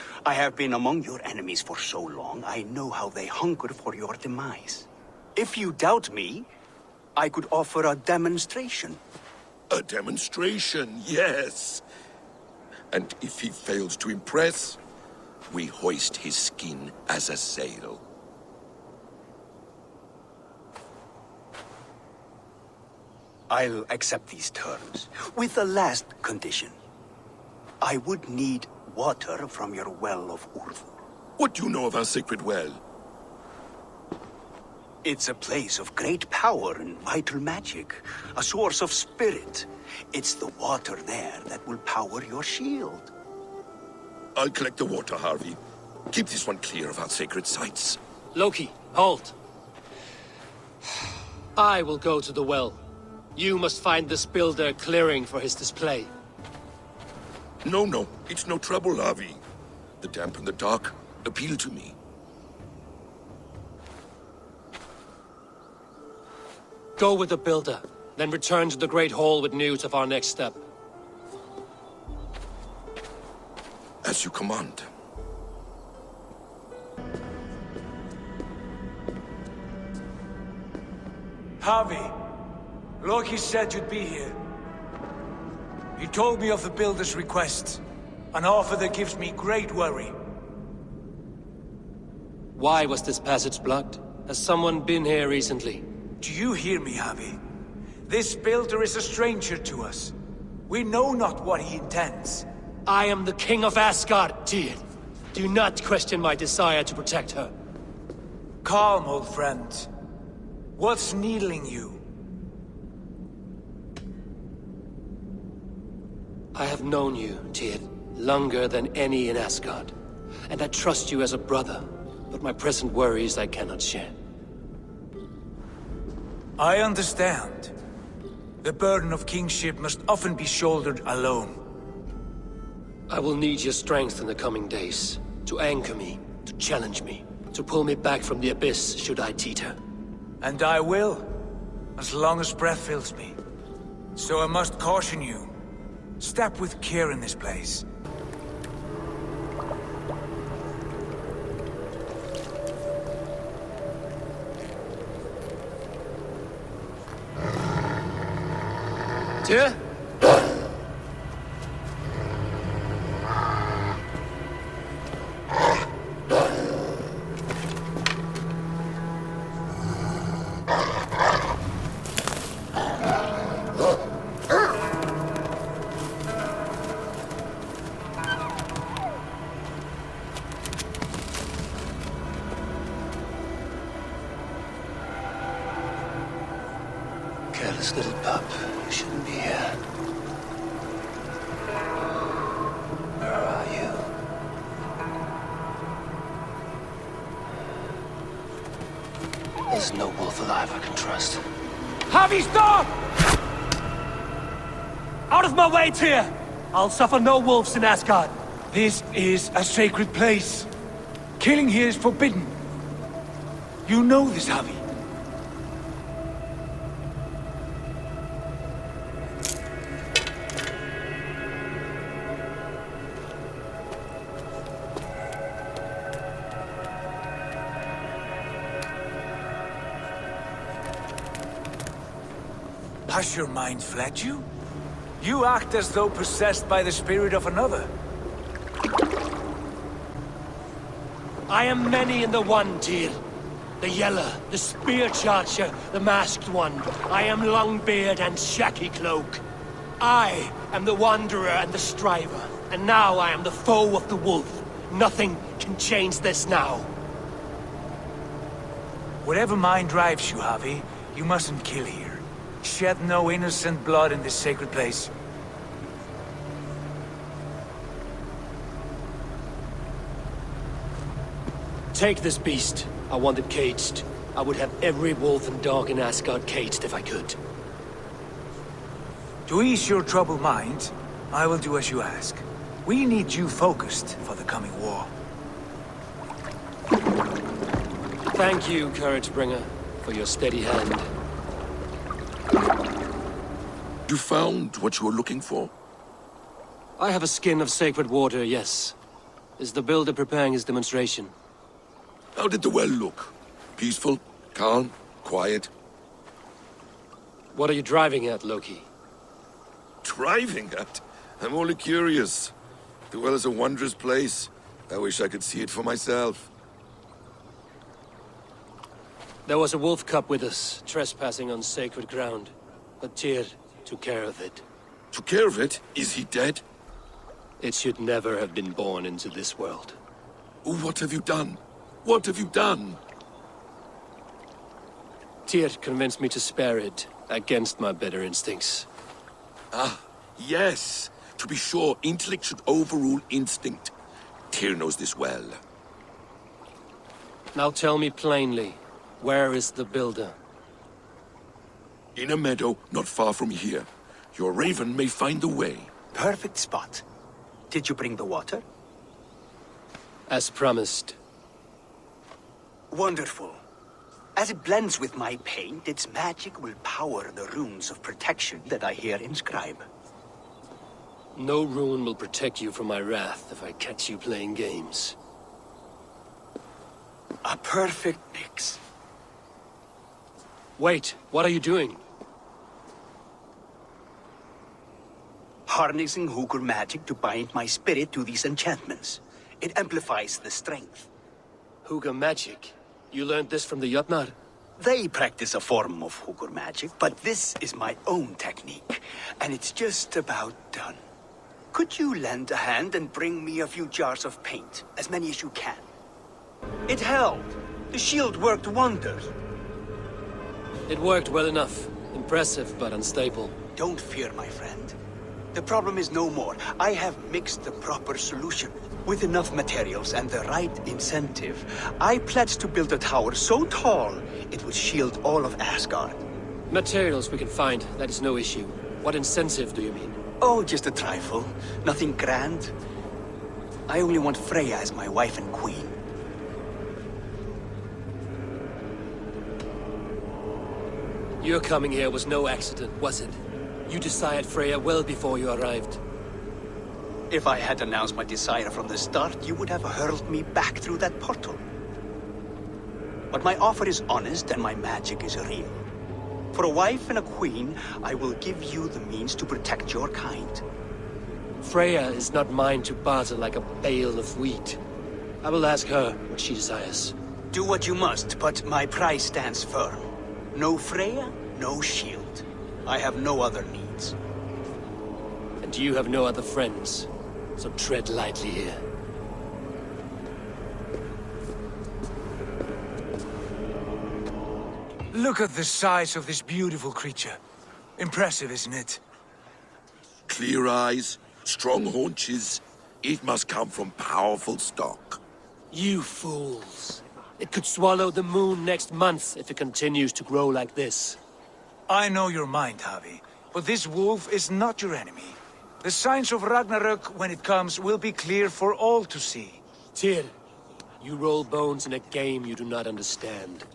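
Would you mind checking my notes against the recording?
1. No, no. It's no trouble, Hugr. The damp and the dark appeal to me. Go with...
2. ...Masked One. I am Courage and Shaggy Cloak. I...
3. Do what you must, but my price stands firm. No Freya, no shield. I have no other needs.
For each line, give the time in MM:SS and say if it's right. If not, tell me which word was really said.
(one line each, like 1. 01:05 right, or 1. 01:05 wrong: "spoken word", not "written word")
1. 00:57 wrong: "Havi", not "Hugr"
2. 04:05 wrong: "Longbeard", not "Courage"
3. 07:47 right.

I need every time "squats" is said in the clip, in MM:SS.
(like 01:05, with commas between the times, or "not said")
not said.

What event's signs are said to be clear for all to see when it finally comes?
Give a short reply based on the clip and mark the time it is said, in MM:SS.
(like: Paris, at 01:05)
Ragnarok, at 08:26.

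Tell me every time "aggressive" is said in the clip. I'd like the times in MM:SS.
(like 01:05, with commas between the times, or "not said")
not said.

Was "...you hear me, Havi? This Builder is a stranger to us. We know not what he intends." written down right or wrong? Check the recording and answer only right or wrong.
right.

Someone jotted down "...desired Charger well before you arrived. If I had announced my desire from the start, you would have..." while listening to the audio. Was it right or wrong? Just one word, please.
wrong.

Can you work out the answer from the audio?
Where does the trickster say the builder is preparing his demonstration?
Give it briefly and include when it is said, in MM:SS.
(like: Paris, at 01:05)
In a meadow, at 05:52.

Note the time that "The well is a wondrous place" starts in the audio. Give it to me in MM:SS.
05:13.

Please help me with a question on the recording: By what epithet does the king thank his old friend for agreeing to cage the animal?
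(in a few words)
Courage Bringer.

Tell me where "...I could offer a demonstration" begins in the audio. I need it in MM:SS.
00:07.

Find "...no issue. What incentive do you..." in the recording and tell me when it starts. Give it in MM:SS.
07:08.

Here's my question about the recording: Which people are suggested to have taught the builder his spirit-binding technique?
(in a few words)
The Jotnar.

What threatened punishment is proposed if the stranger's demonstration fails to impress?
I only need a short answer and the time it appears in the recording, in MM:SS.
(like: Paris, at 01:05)
Hoist his skin as a sail, at 00:15.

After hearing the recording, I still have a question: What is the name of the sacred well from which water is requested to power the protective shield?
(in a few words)
Urthur.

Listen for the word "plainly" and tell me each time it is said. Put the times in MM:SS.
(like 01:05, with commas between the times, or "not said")
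05:48.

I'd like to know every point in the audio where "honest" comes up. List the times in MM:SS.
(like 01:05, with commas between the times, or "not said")
07:34.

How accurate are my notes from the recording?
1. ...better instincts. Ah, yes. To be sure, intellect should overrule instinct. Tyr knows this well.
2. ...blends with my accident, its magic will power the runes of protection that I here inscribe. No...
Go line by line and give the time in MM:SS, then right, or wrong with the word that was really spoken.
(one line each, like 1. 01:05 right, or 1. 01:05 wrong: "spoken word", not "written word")
1. 05:37 right
2. 06:04 wrong: "paint", not "accident".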